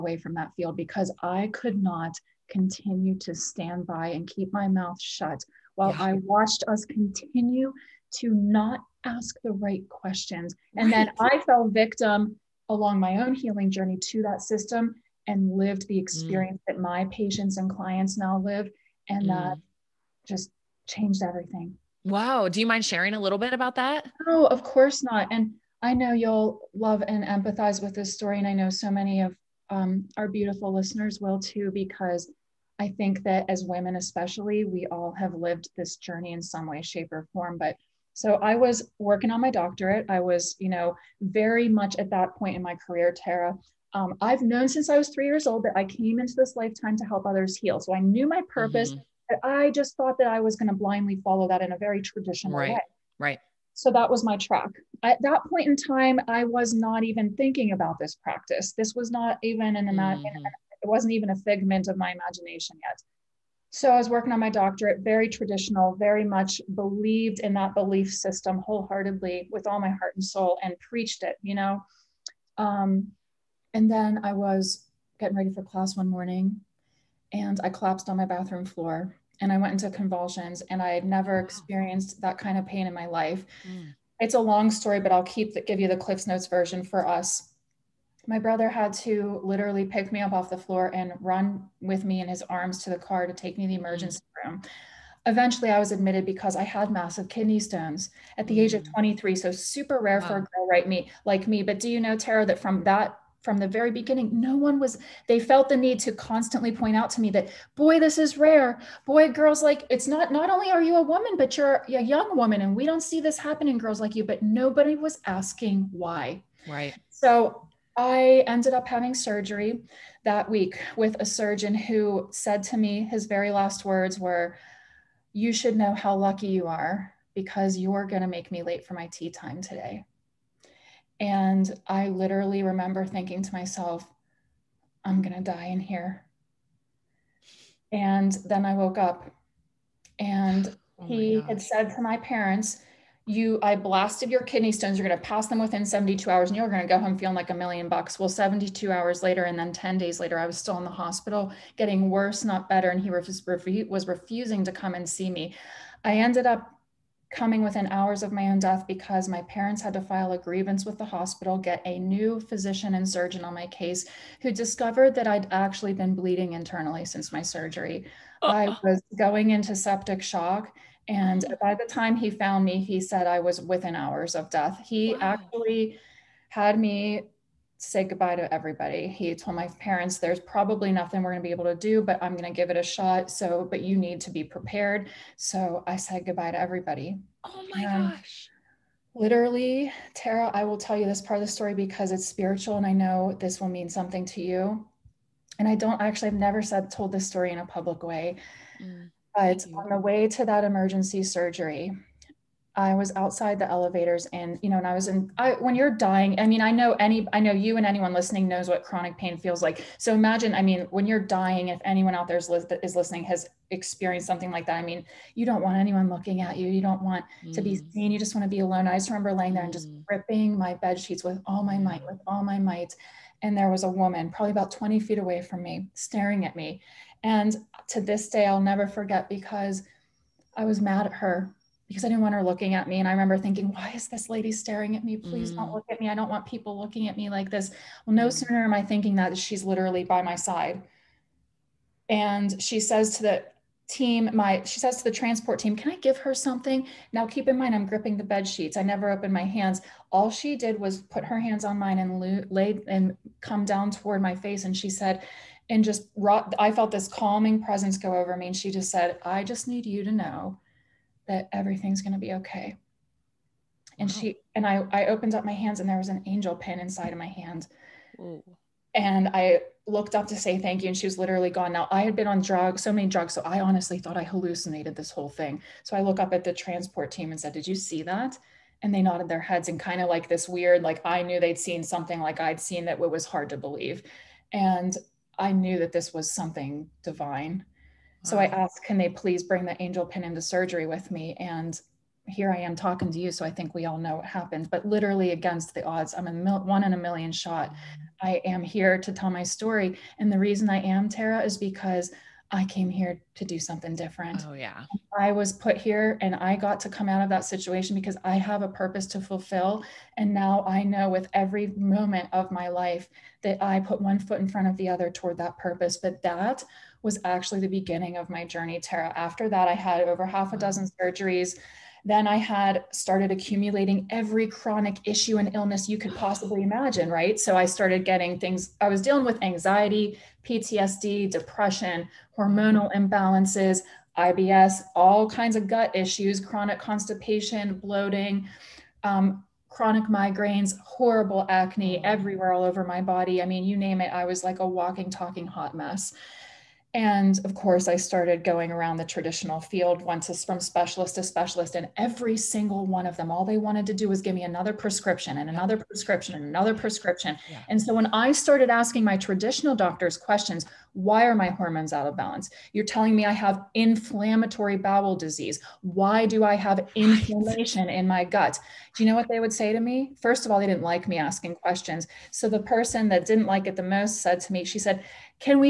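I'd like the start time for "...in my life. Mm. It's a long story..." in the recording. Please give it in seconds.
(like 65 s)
82 s.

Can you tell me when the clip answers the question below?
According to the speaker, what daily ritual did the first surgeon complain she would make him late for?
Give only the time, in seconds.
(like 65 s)
129 s.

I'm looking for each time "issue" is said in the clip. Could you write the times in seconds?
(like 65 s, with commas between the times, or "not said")
325 s, 335 s.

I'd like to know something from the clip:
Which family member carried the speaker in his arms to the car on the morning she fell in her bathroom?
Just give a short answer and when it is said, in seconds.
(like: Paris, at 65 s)
brother, at 88 s.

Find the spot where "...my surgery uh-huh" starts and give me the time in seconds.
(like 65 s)
167 s.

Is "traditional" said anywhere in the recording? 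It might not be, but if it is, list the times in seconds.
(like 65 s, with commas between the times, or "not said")
52 s, 65 s, 349 s, 359 s.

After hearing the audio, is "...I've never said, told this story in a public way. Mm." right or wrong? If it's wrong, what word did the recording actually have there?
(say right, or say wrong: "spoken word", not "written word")
right.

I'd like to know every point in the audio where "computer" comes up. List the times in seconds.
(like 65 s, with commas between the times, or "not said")
not said.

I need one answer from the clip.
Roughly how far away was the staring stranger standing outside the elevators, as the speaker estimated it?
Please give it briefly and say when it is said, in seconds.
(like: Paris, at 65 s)
20 feet, at 224 s.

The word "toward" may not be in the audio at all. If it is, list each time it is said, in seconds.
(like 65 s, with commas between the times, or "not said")
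253 s, 315 s.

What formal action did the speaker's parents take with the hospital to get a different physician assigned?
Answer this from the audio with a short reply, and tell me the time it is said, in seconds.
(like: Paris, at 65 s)
file a grievance, at 160 s.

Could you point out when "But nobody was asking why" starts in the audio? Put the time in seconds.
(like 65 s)
114 s.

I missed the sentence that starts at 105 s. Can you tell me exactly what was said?
They felt the need to constantly point out to me that, boy, this is rare.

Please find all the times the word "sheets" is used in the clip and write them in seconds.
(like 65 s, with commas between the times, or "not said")
220 s, 248 s.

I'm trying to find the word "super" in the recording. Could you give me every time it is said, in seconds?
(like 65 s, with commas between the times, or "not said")
99 s.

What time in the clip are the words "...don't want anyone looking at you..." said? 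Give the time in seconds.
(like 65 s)
215 s.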